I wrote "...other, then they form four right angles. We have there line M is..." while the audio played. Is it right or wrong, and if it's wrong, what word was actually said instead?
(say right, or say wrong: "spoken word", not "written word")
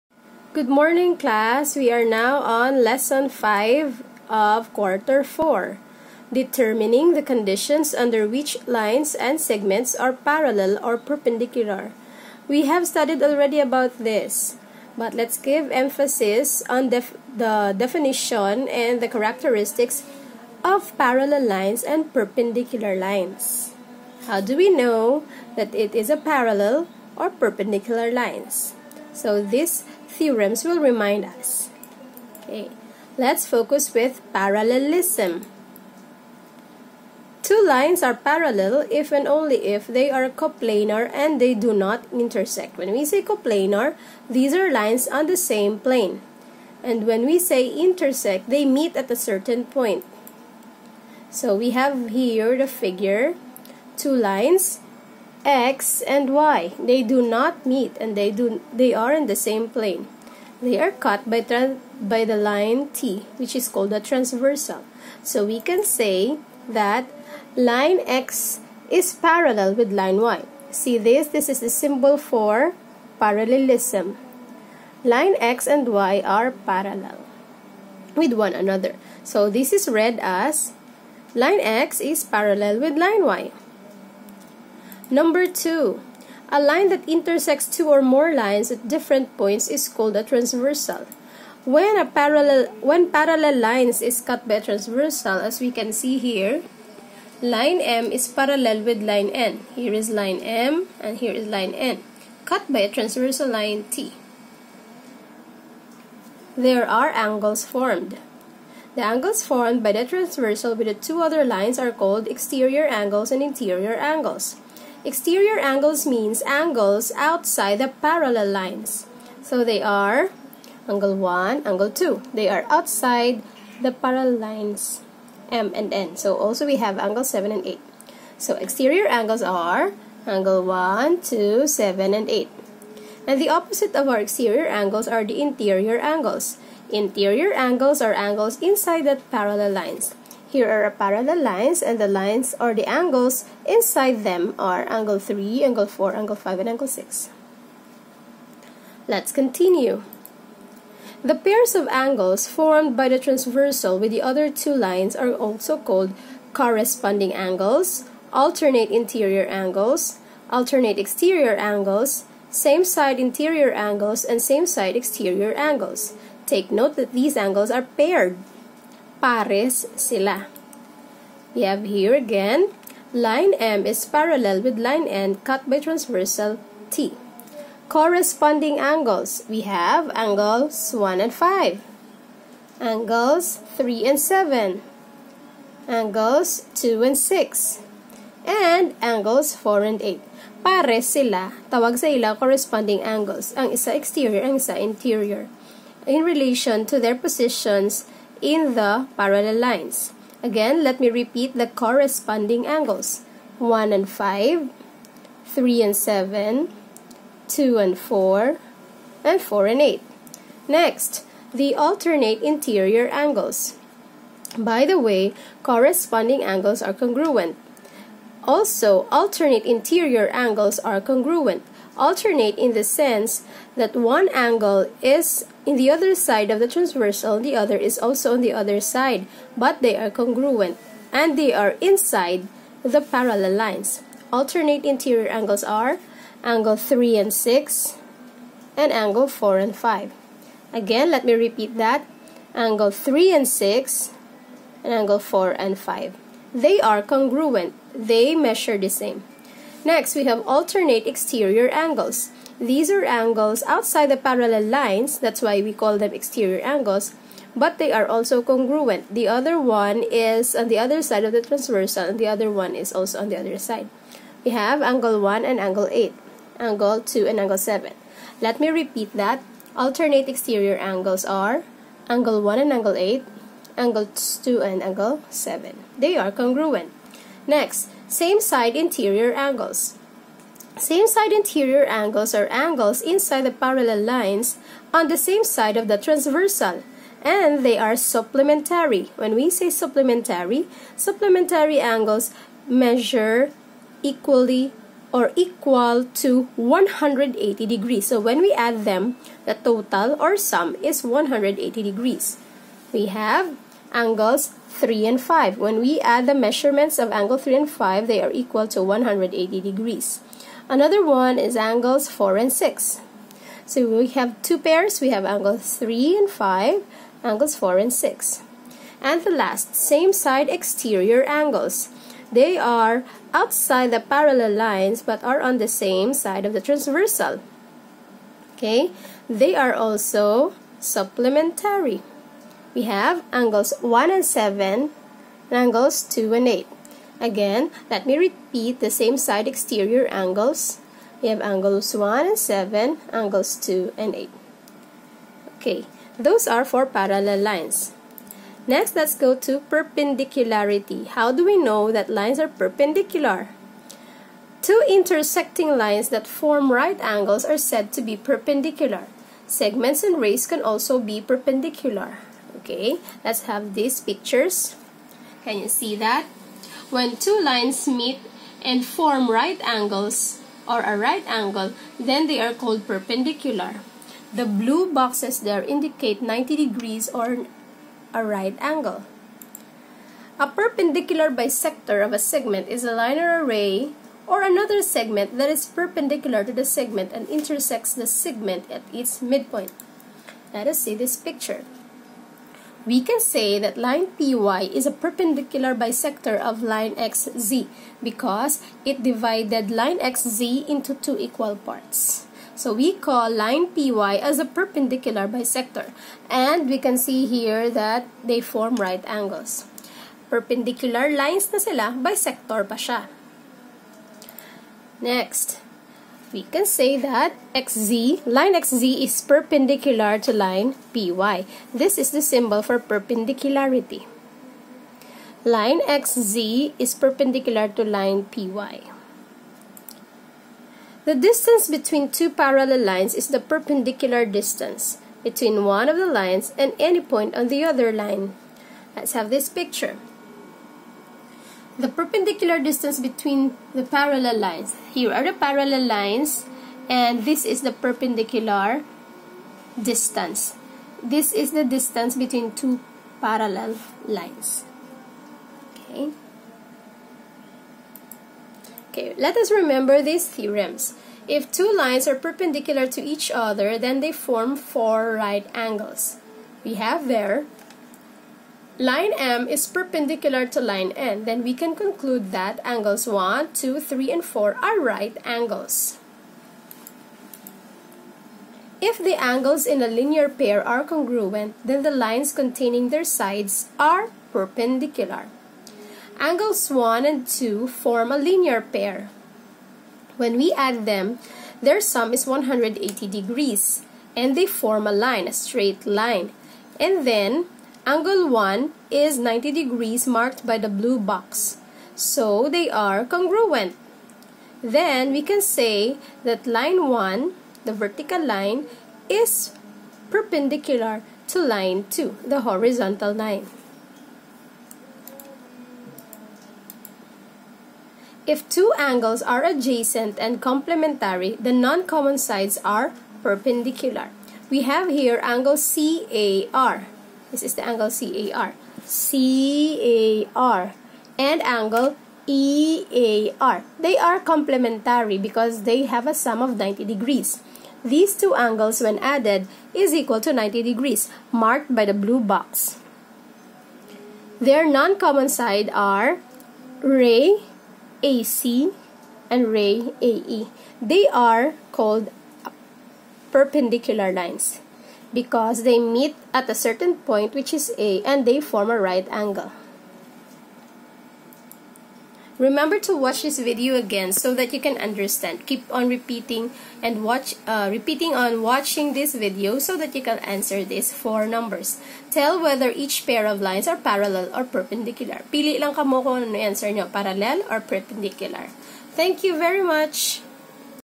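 right.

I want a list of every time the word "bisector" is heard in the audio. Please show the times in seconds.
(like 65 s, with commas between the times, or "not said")
381 s, 395 s, 405 s, 411 s.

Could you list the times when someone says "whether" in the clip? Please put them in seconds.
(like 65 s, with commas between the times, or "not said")
572 s.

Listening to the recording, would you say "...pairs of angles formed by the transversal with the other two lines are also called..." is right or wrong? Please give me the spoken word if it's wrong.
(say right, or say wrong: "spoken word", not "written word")
right.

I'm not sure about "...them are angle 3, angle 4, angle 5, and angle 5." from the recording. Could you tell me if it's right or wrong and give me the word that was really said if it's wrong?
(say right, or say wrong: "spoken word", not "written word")
wrong: "6", not "5".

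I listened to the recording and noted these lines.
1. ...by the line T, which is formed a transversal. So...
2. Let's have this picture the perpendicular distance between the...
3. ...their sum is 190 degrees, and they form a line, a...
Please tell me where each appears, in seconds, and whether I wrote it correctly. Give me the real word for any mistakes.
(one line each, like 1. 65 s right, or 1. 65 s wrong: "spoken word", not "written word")
1. 61 s wrong: "called", not "formed"
2. 438 s right
3. 491 s wrong: "180", not "190".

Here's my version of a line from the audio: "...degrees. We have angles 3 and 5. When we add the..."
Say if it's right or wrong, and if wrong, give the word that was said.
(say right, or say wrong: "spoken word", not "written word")
right.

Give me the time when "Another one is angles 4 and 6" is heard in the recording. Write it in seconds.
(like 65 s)
310 s.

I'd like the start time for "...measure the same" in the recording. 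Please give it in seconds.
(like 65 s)
248 s.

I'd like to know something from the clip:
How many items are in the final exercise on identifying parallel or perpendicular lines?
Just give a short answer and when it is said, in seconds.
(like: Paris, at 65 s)
4, at 570 s.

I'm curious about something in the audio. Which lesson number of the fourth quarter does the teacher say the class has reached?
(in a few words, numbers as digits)
5.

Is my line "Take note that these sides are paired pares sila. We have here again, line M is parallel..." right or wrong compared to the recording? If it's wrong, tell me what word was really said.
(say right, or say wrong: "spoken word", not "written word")
wrong: "angles", not "sides".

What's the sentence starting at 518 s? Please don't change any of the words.
If two angles are adjacent and complementary, the non-common sides are perpendicular.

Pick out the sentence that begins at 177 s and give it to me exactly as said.
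Corresponding angles, we have angles 1 and 5, angles 3 and 7, angles 2 and 6, and angles 4 and 8.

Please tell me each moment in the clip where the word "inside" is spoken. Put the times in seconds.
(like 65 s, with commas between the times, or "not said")
138 s, 143 s, 231 s, 283 s.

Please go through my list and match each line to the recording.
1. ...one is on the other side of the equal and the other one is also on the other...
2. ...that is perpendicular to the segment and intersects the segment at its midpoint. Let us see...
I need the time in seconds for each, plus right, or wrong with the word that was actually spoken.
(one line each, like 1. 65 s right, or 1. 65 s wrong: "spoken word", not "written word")
1. 259 s wrong: "transversal", not "equal"
2. 385 s right.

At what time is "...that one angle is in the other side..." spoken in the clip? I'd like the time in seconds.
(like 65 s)
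223 s.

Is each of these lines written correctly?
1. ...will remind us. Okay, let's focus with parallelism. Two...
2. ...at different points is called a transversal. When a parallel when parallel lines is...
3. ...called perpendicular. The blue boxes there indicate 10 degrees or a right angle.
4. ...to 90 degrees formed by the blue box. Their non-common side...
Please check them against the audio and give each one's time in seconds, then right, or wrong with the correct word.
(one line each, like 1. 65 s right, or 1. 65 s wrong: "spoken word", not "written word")
1. 30 s right
2. 88 s right
3. 372 s wrong: "90", not "10"
4. 540 s wrong: "marked", not "formed".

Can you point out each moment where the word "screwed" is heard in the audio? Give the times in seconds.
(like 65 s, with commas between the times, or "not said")
not said.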